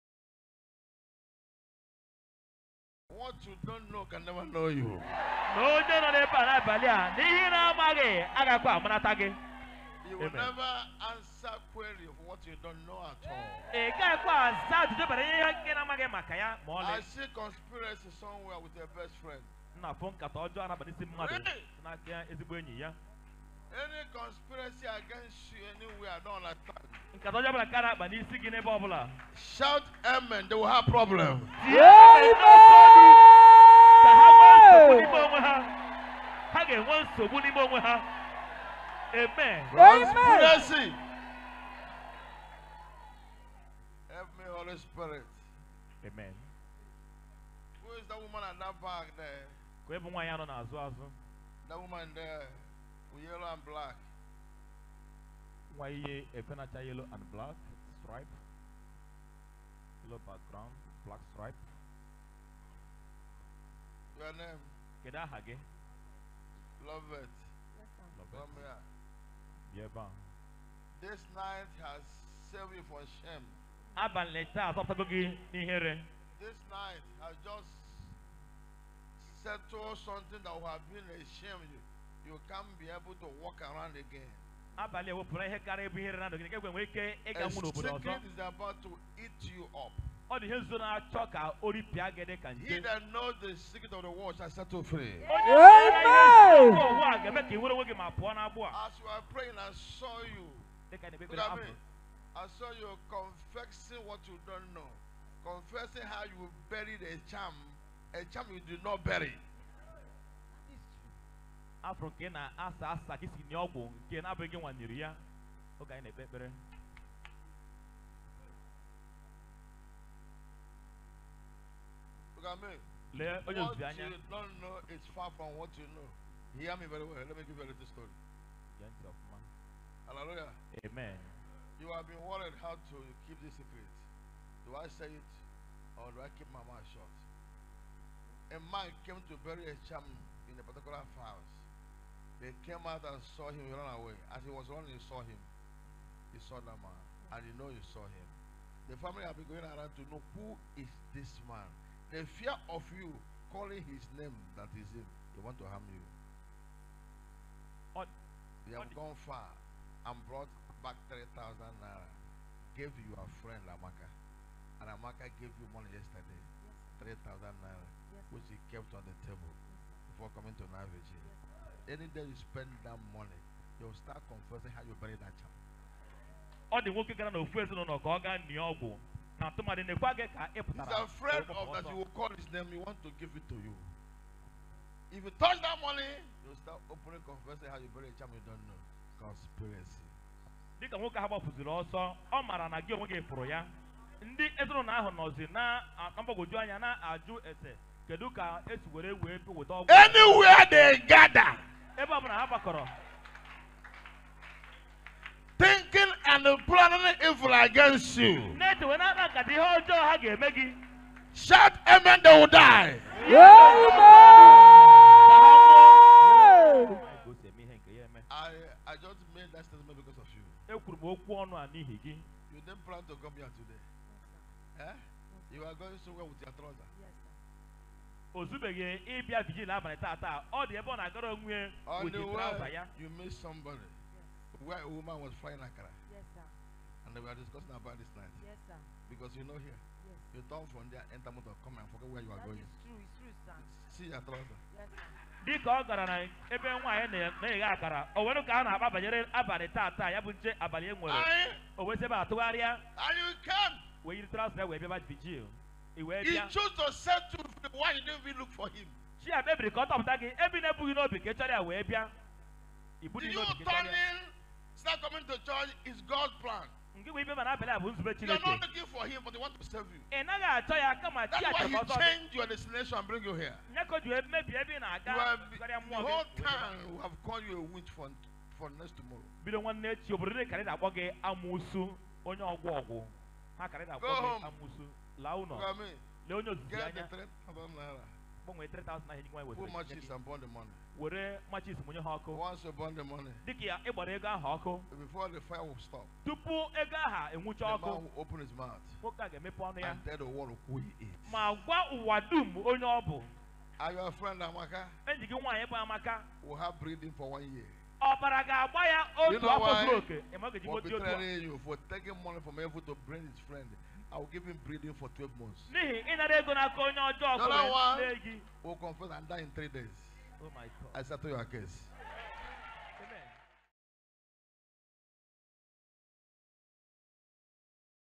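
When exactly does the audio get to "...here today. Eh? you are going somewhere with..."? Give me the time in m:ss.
3:43.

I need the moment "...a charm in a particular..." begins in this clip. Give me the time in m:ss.
2:19.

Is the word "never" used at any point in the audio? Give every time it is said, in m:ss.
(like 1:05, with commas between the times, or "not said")
0:04, 0:10.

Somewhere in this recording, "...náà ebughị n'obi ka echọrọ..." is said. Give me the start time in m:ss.
4:20.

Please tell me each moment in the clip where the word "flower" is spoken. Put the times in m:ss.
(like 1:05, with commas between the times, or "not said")
not said.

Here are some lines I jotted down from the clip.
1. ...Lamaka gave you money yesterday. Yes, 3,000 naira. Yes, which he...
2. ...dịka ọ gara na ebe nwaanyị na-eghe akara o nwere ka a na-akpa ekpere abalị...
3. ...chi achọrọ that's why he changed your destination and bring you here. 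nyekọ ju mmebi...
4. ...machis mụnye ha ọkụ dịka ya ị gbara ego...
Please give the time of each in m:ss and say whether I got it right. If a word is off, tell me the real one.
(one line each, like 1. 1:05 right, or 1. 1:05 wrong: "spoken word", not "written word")
1. 2:44 right
2. 4:05 wrong: "banyere", not "ekpere"
3. 4:31 right
4. 4:51 right.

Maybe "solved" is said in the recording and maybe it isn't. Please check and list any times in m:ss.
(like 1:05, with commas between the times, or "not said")
not said.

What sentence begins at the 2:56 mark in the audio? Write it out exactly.
Ọ dị nwoke gara n'ofu ezinụlọ ka ọ gaa nnịa ọgwụ na tụmadị na-ekwe gị ka ị pụtara.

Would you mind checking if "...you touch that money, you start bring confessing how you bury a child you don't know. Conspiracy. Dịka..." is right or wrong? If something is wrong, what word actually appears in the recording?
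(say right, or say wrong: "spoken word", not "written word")
wrong: "opening", not "bring".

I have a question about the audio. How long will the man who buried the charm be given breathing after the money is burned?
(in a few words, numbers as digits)
12 months.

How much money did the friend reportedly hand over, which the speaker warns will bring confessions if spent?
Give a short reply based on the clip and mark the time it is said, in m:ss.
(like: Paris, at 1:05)
3,000 naira, at 2:41.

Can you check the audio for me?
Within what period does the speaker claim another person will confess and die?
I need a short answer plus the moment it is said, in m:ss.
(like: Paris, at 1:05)
three days, at 5:19.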